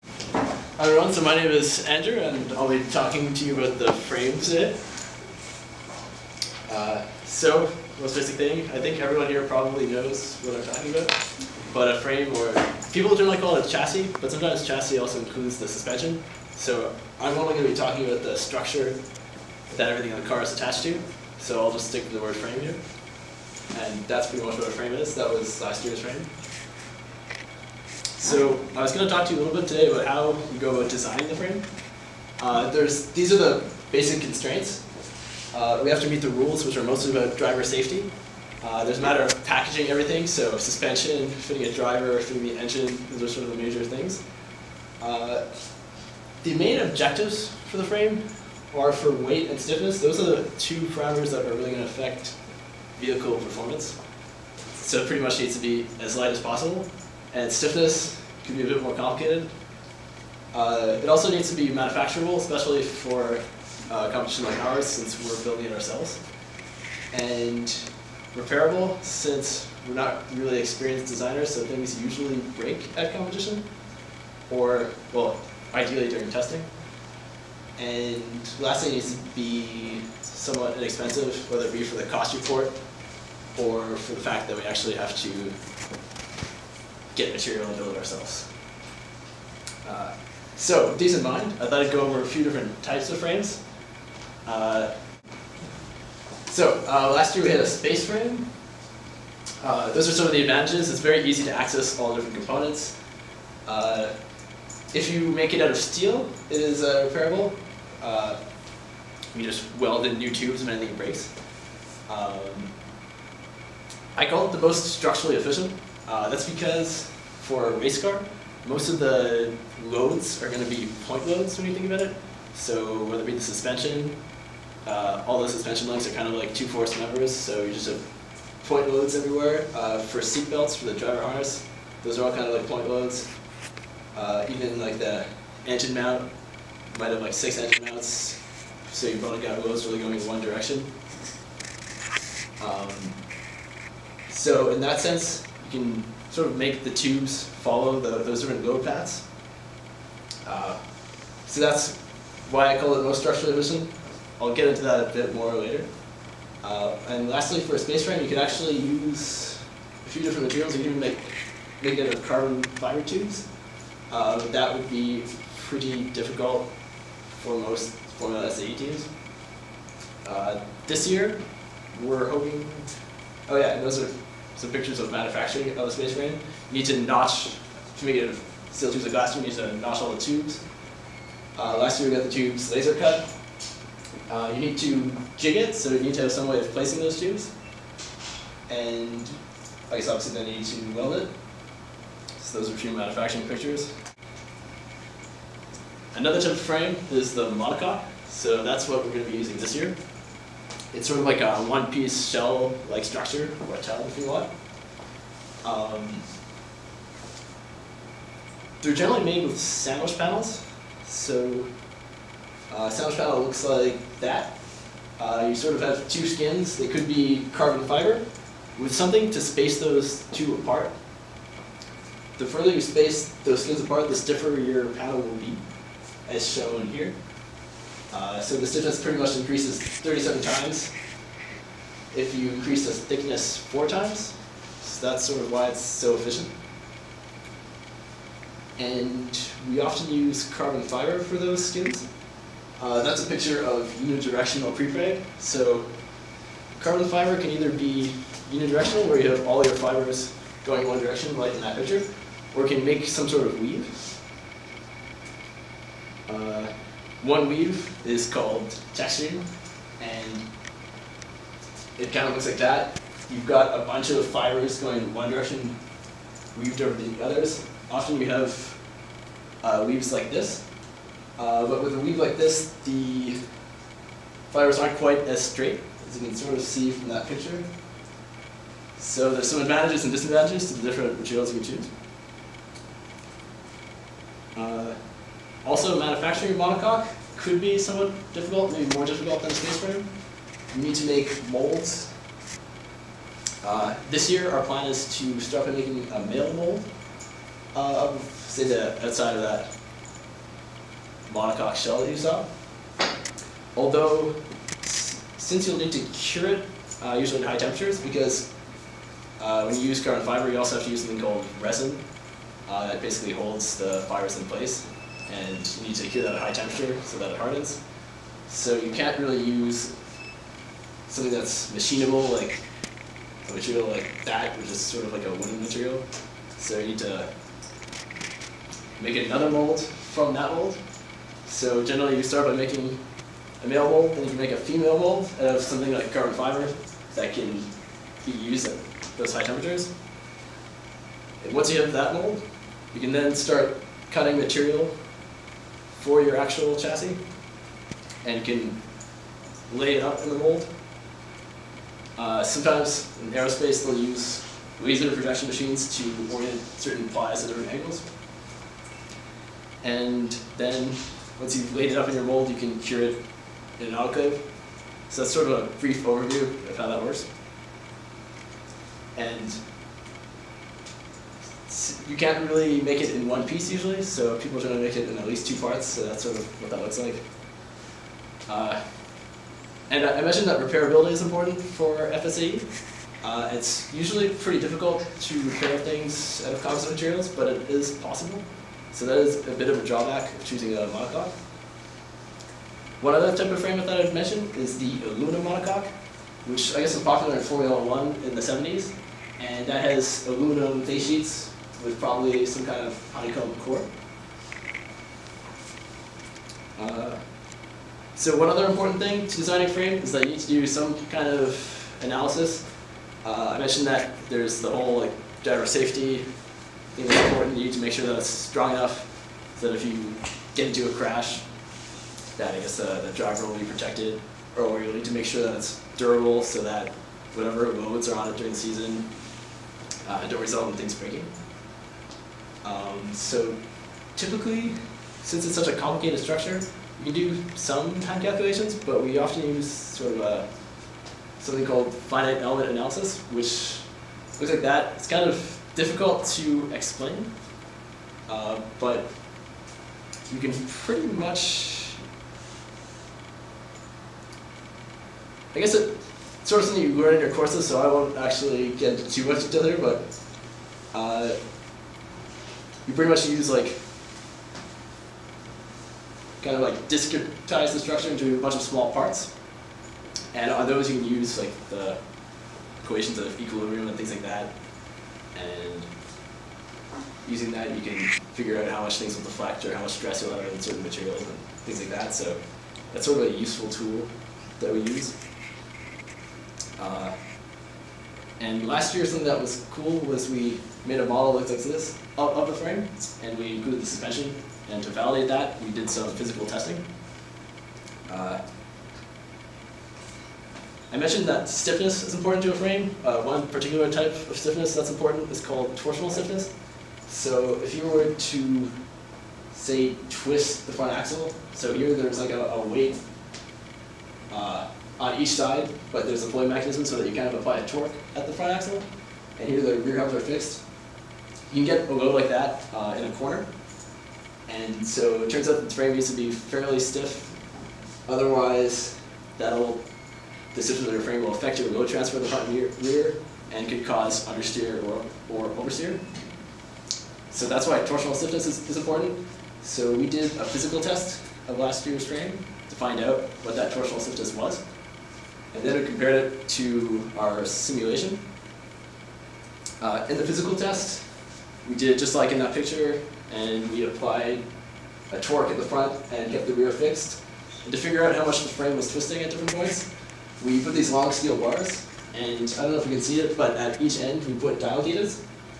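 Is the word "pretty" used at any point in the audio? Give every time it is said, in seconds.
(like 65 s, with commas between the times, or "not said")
24 s, 55 s, 165 s, 229 s, 384 s, 450 s, 462 s.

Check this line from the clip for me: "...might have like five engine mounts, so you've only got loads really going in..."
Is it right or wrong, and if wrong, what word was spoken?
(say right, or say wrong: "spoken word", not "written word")
wrong: "six", not "five".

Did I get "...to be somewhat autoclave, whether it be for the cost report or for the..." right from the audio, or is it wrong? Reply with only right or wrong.
wrong.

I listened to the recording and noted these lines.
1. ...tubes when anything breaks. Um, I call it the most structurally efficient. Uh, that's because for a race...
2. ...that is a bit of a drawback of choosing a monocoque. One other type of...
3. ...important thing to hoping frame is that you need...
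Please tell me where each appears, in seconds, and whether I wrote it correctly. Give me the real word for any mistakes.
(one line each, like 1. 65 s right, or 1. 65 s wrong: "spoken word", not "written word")
1. 110 s right
2. 389 s right
3. 408 s wrong: "designing", not "hoping".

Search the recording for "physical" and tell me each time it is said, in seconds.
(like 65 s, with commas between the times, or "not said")
496 s, 540 s, 550 s.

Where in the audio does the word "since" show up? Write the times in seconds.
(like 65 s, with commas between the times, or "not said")
64 s, 69 s, 304 s, 435 s.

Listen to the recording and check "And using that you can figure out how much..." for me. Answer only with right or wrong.
right.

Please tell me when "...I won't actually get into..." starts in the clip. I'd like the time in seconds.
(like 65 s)
457 s.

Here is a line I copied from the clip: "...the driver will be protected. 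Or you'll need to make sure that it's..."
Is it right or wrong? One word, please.
right.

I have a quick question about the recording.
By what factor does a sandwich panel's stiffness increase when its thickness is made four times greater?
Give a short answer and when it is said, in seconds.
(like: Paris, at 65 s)
37, at 229 s.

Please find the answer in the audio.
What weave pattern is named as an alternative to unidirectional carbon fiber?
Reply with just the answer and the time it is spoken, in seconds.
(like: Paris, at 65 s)
texturing, at 258 s.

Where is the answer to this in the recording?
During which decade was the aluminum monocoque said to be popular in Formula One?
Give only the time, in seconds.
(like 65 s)
398 s.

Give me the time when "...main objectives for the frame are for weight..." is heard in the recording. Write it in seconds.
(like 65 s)
46 s.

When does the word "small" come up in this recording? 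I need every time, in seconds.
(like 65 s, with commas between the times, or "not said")
468 s.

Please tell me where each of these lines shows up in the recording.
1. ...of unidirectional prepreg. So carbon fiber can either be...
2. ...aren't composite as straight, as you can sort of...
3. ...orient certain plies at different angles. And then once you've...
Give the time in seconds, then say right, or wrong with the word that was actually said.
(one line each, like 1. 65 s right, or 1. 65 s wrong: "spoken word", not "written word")
1. 243 s right
2. 274 s wrong: "quite", not "composite"
3. 356 s right.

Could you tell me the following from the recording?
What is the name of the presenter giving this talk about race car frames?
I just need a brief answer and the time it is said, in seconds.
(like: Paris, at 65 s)
Andrew, at 1 s.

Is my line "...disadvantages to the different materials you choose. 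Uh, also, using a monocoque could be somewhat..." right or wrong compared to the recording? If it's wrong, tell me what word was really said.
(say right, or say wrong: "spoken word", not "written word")
wrong: "manufacturing", not "using".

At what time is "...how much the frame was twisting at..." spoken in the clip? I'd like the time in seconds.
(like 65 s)
558 s.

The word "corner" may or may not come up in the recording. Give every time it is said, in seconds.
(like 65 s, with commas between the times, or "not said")
523 s.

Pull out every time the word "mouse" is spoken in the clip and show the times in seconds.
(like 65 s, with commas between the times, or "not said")
not said.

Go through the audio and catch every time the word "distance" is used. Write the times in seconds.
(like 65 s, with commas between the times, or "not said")
not said.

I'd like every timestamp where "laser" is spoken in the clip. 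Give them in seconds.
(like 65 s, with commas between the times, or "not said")
182 s, 354 s.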